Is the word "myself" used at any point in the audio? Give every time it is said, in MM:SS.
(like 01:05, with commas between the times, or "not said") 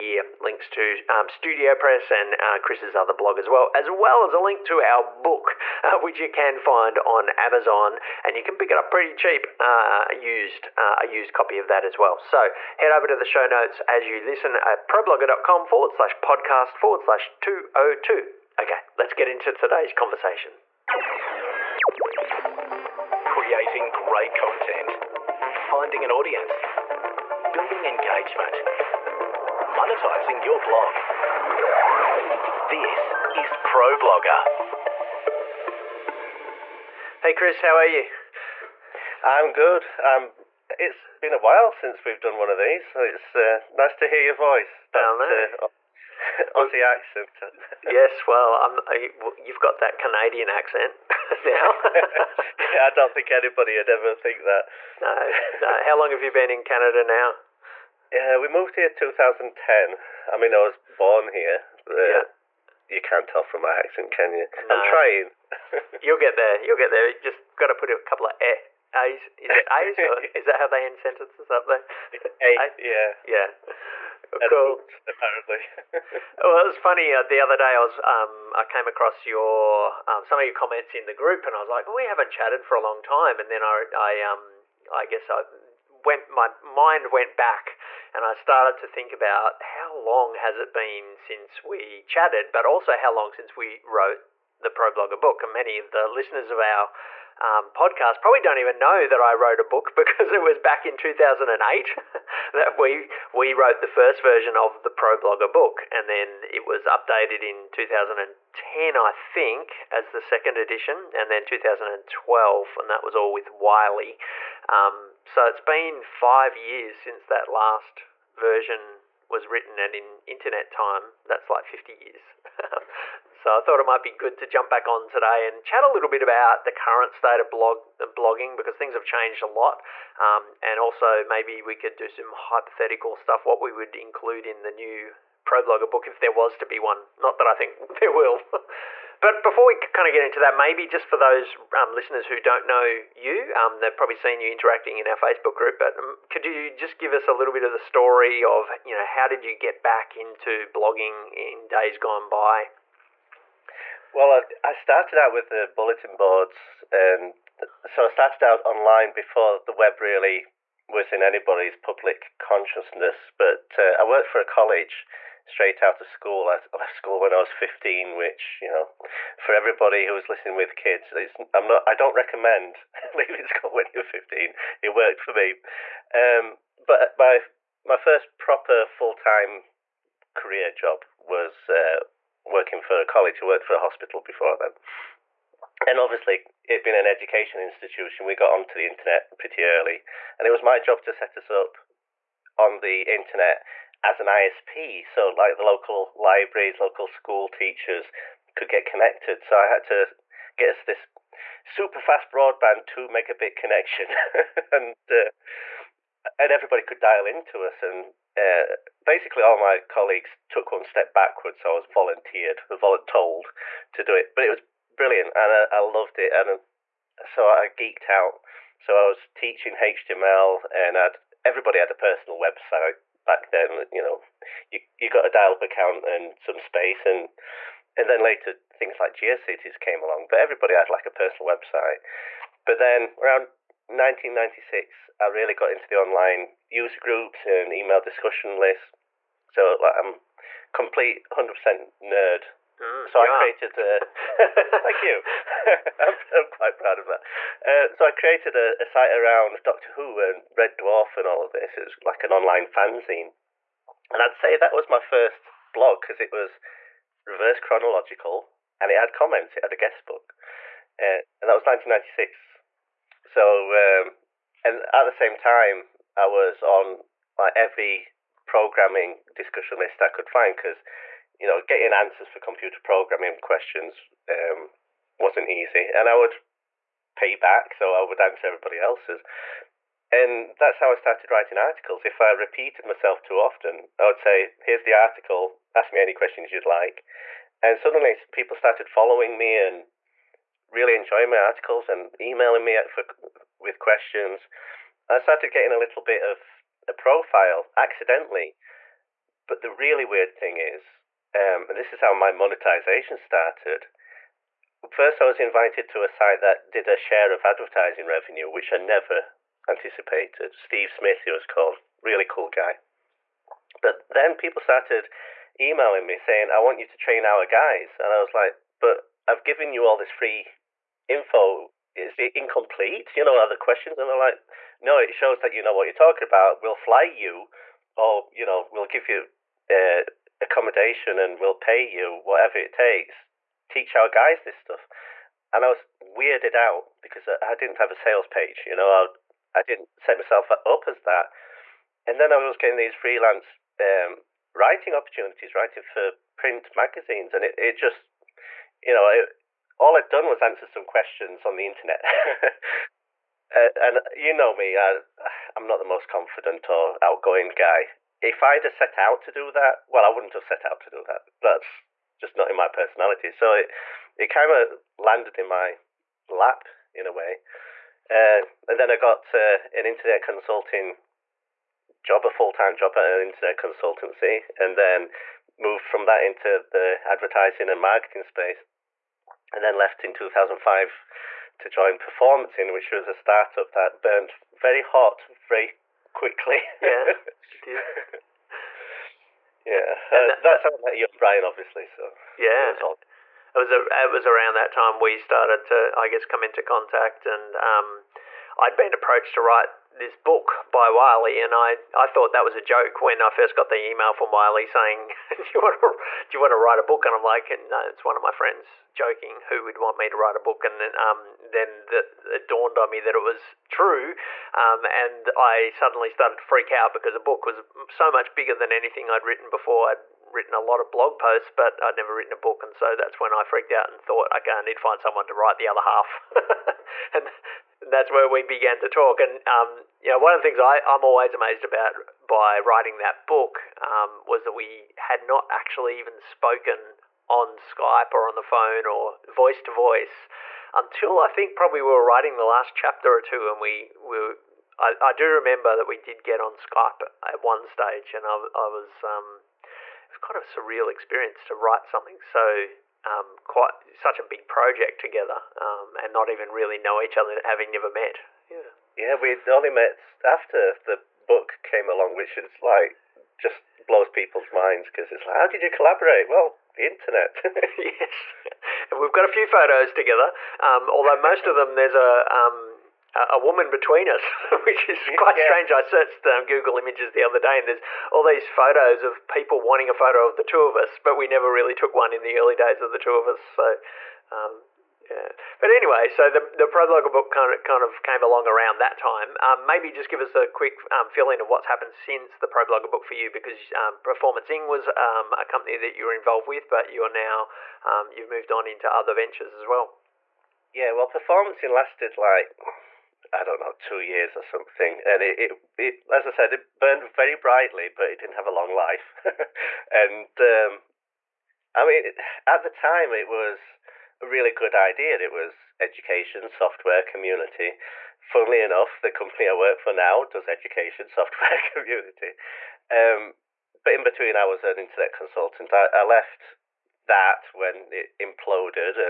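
04:42, 05:40.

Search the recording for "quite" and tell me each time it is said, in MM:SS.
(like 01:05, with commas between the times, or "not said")
04:06, 07:33, 07:55.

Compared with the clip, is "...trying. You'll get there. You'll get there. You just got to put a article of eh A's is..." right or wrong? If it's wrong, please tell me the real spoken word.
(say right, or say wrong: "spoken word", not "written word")
wrong: "couple", not "article".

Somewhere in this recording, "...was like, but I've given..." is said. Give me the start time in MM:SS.
05:18.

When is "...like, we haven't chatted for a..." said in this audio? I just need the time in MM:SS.
01:21.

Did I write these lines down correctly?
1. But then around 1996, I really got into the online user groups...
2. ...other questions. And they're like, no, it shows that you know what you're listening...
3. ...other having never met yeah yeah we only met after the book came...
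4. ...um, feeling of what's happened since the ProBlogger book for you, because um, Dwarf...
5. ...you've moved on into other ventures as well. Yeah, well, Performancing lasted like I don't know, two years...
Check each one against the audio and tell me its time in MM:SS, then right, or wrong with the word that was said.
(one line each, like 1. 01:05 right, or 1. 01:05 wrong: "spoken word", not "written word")
1. 03:52 right
2. 05:23 wrong: "talking", not "listening"
3. 07:37 right
4. 08:10 wrong: "Performancing", not "Dwarf"
5. 08:18 right.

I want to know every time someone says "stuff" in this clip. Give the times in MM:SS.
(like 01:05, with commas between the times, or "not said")
02:13, 05:34.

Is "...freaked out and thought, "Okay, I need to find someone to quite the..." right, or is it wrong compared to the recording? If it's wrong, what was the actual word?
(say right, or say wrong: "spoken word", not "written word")
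wrong: "write", not "quite".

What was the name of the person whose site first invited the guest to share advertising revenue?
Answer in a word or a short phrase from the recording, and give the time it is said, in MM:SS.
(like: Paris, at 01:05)
Steve Smith, at 05:10.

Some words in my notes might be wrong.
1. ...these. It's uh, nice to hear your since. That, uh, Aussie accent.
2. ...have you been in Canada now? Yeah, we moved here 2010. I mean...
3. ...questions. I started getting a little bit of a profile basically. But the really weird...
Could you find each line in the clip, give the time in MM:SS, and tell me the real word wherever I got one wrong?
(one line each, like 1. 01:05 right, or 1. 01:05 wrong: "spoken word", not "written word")
1. 00:42 wrong: "voice", not "since"
2. 00:56 right
3. 04:53 wrong: "accidentally", not "basically".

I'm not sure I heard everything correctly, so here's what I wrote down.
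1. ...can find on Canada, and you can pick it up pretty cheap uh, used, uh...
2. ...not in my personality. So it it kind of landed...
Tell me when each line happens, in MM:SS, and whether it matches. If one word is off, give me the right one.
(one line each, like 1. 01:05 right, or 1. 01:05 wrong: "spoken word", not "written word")
1. 00:06 wrong: "Amazon", not "Canada"
2. 06:02 right.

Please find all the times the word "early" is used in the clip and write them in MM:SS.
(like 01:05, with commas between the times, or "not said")
03:09, 08:02.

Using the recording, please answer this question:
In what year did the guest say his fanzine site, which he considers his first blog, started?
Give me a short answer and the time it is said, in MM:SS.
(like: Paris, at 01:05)
1996, at 04:21.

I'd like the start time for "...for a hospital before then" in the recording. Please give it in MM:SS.
03:03.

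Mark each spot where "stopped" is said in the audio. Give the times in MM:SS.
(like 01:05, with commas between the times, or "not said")
not said.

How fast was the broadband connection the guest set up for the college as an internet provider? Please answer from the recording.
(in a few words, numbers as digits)
2 megabit.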